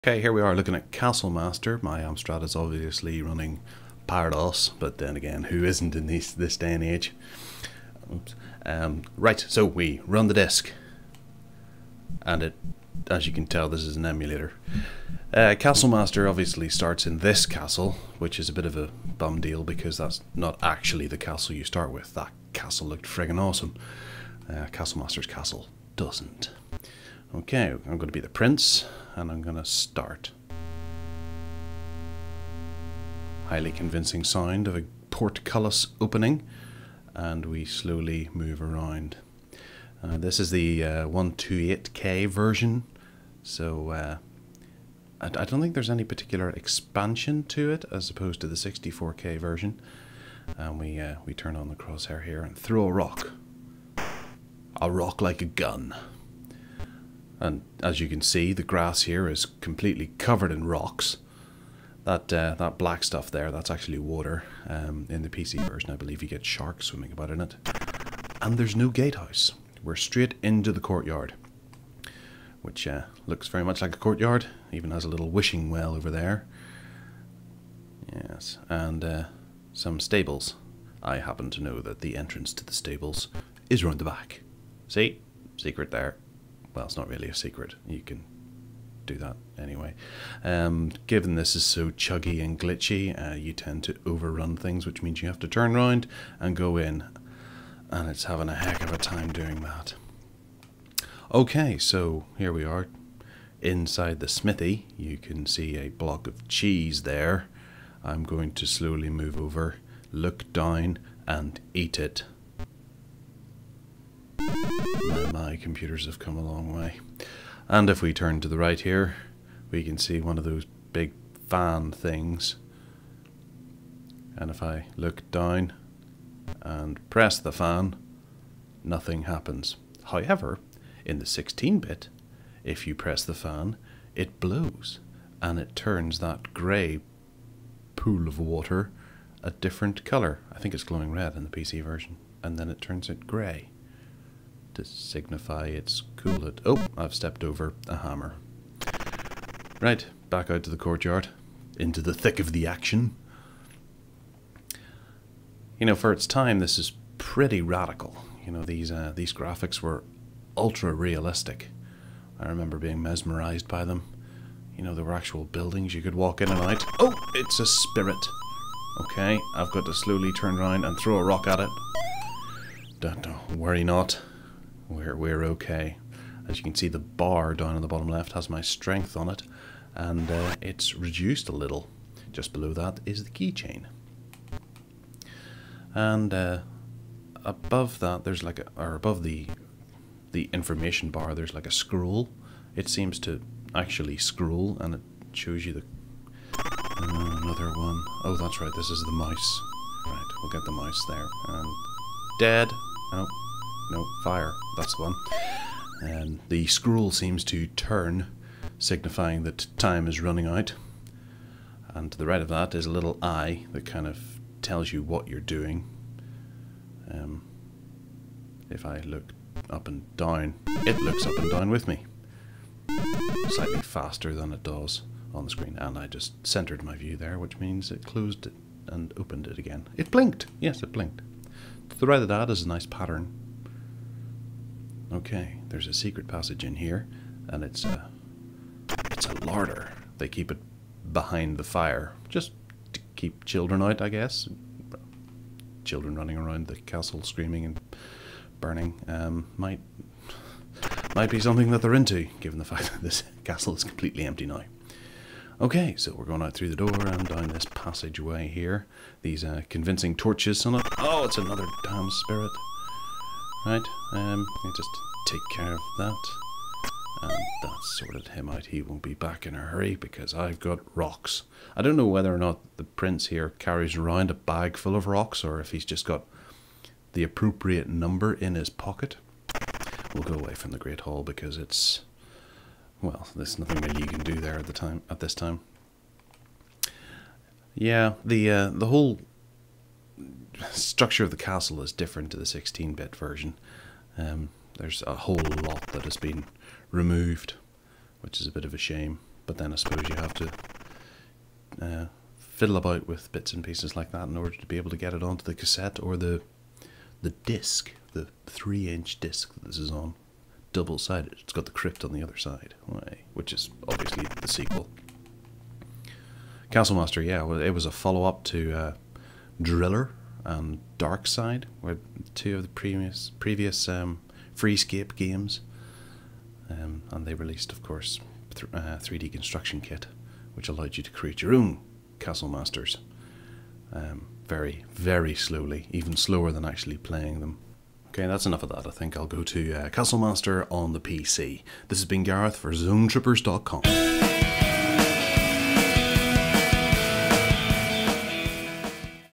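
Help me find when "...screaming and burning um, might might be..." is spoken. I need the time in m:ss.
4:07.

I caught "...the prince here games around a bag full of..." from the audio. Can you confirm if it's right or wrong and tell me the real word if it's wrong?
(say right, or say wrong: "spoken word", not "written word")
wrong: "carries", not "games".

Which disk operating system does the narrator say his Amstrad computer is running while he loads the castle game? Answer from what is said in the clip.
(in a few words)
ParaDOS.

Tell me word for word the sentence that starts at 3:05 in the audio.
And uh, above that, there's like a, or above the the information bar, there's like a scroll.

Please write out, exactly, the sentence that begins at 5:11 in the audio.
It's got the crypt on the other side, which is obviously the sequel.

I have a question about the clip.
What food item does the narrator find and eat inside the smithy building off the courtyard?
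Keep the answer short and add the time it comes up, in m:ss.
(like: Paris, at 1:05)
Cheese, at 1:46.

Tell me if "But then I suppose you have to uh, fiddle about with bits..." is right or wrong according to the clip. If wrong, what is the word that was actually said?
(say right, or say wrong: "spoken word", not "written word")
right.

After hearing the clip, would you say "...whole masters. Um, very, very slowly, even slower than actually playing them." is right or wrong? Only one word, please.
wrong.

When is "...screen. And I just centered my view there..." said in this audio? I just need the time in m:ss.
3:45.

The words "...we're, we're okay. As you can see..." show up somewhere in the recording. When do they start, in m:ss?
2:54.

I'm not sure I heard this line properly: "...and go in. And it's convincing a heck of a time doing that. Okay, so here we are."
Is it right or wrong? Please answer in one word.
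wrong.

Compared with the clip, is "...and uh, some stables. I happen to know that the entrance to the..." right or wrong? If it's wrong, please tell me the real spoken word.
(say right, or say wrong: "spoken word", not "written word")
right.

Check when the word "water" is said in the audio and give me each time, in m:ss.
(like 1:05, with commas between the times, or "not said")
1:03, 2:18.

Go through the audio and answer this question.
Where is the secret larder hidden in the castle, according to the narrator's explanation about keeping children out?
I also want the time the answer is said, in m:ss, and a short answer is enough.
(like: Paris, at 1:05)
Behind the fire, at 4:01.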